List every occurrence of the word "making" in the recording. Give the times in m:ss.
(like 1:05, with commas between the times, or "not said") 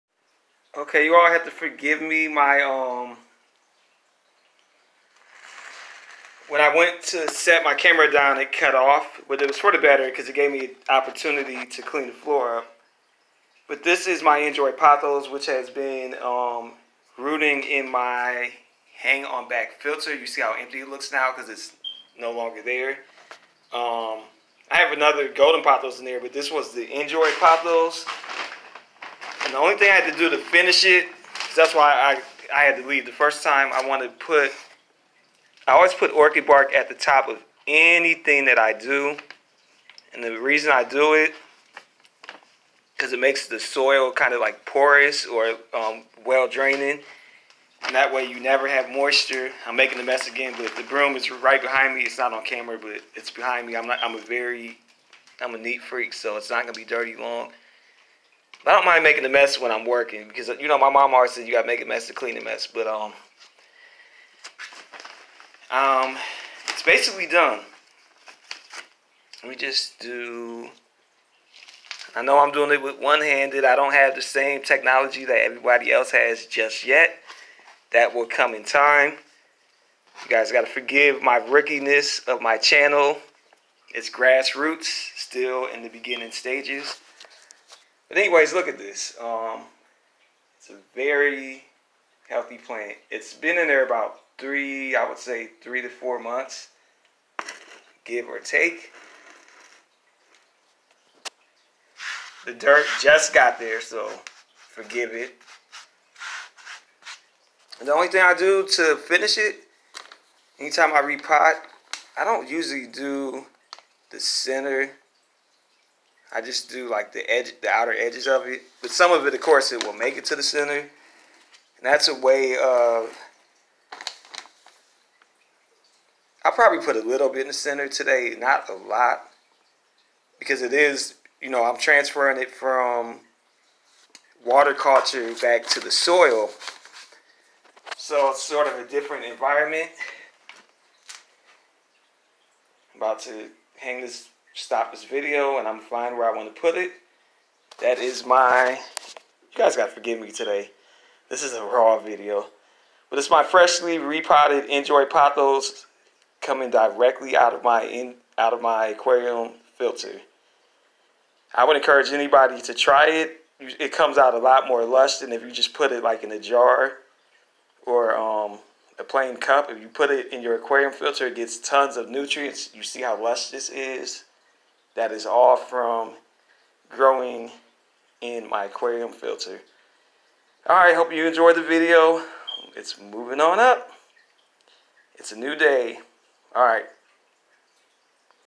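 0:49, 0:59.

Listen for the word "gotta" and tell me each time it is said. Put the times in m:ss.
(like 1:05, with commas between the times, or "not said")
1:01, 1:20.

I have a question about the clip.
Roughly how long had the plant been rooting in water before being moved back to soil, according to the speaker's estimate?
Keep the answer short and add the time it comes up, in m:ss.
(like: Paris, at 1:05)
3 to 4 months, at 1:35.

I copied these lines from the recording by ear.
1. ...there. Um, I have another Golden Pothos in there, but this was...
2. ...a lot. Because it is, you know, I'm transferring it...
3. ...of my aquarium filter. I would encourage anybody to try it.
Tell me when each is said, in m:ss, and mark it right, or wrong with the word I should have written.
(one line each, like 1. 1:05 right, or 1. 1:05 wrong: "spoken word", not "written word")
1. 0:22 right
2. 2:08 right
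3. 2:38 right.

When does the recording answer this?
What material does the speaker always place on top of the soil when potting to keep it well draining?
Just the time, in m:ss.
0:36.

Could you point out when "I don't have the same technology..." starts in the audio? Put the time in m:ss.
1:13.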